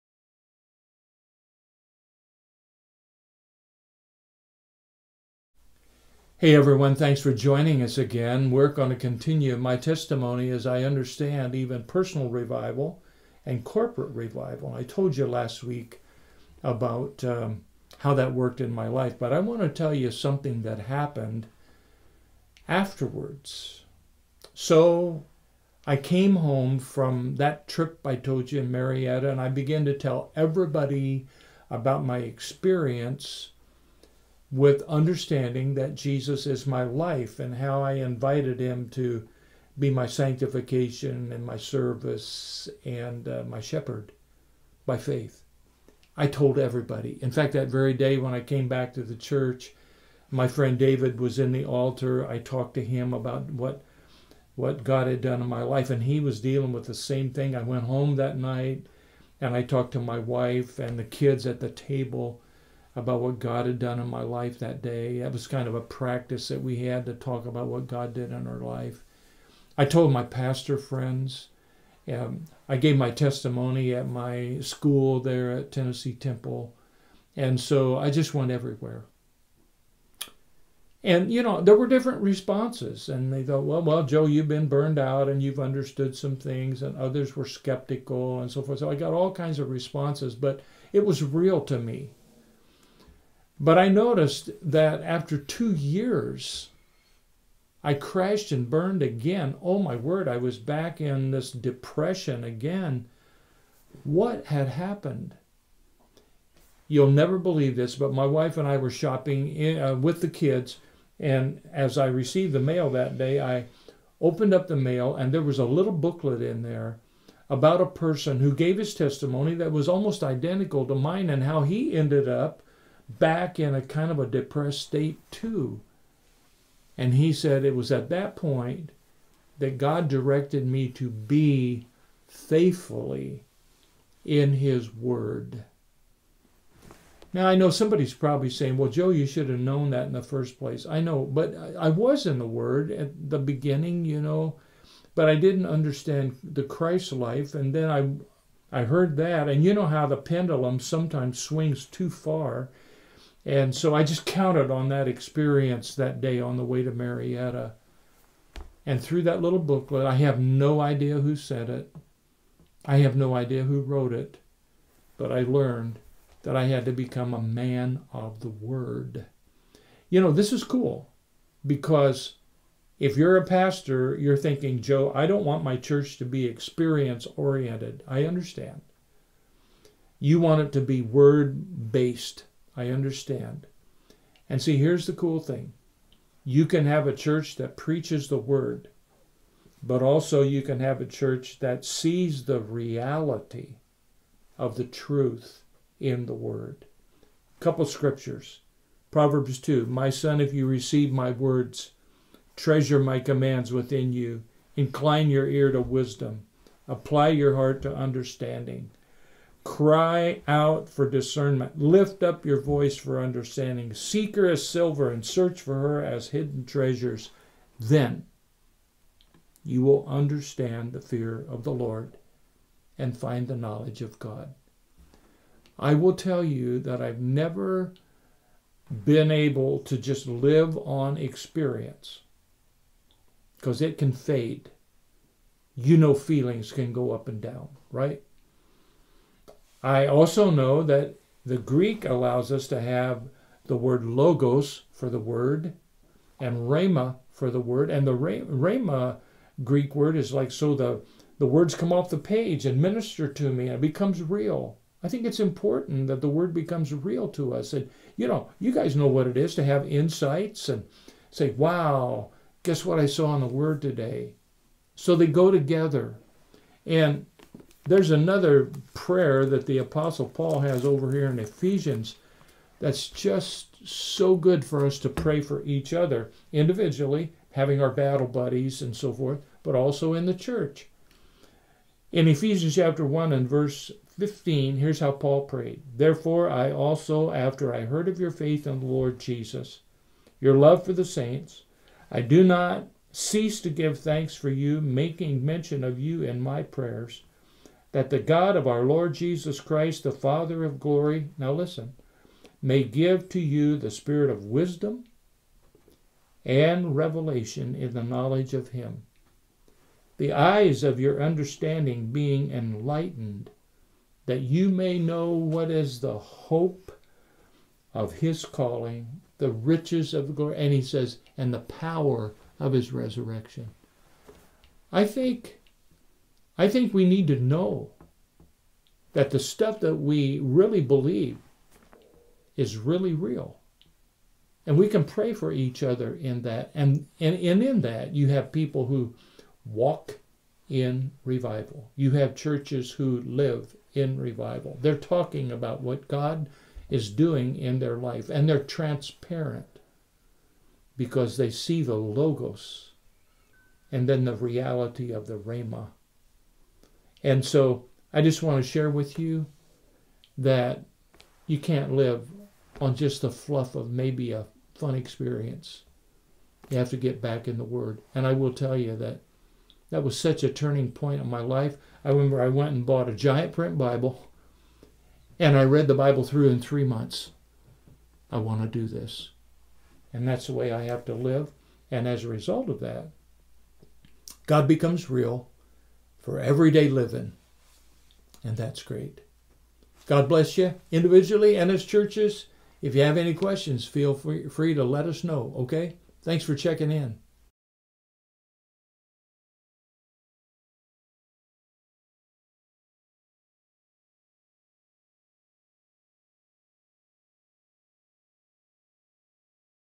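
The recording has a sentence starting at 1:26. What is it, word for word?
And others were skeptical and so forth.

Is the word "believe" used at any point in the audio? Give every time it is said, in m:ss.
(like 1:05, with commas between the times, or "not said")
1:47, 5:30.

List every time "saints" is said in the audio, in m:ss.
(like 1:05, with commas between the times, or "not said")
4:51.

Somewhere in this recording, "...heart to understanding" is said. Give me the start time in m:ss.
3:27.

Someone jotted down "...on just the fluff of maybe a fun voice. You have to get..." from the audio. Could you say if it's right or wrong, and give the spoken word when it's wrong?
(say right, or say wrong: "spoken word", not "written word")
wrong: "experience", not "voice".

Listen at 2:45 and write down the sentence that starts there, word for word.
But I learned that I had to become a man of the word.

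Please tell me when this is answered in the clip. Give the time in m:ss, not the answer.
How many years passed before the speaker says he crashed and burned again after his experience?
1:35.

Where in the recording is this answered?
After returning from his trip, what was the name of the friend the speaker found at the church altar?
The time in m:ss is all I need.
0:50.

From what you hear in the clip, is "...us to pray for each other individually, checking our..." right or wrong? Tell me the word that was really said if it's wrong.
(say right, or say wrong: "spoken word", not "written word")
wrong: "having", not "checking".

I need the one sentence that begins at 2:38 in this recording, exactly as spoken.
And through that little booklet, I have no idea who said it.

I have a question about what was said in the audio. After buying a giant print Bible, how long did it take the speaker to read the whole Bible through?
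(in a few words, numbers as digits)
3 months.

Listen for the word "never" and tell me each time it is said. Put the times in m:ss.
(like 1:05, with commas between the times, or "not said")
1:47, 3:47.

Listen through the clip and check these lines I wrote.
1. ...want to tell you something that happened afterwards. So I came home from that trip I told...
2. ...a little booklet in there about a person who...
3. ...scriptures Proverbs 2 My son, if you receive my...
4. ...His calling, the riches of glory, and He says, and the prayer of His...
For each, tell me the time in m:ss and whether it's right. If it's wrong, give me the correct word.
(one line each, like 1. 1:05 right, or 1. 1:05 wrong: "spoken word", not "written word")
1. 0:19 right
2. 1:55 right
3. 3:17 right
4. 5:18 wrong: "power", not "prayer".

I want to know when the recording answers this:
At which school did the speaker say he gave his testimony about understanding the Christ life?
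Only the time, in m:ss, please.
1:15.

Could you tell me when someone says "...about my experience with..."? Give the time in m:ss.
0:31.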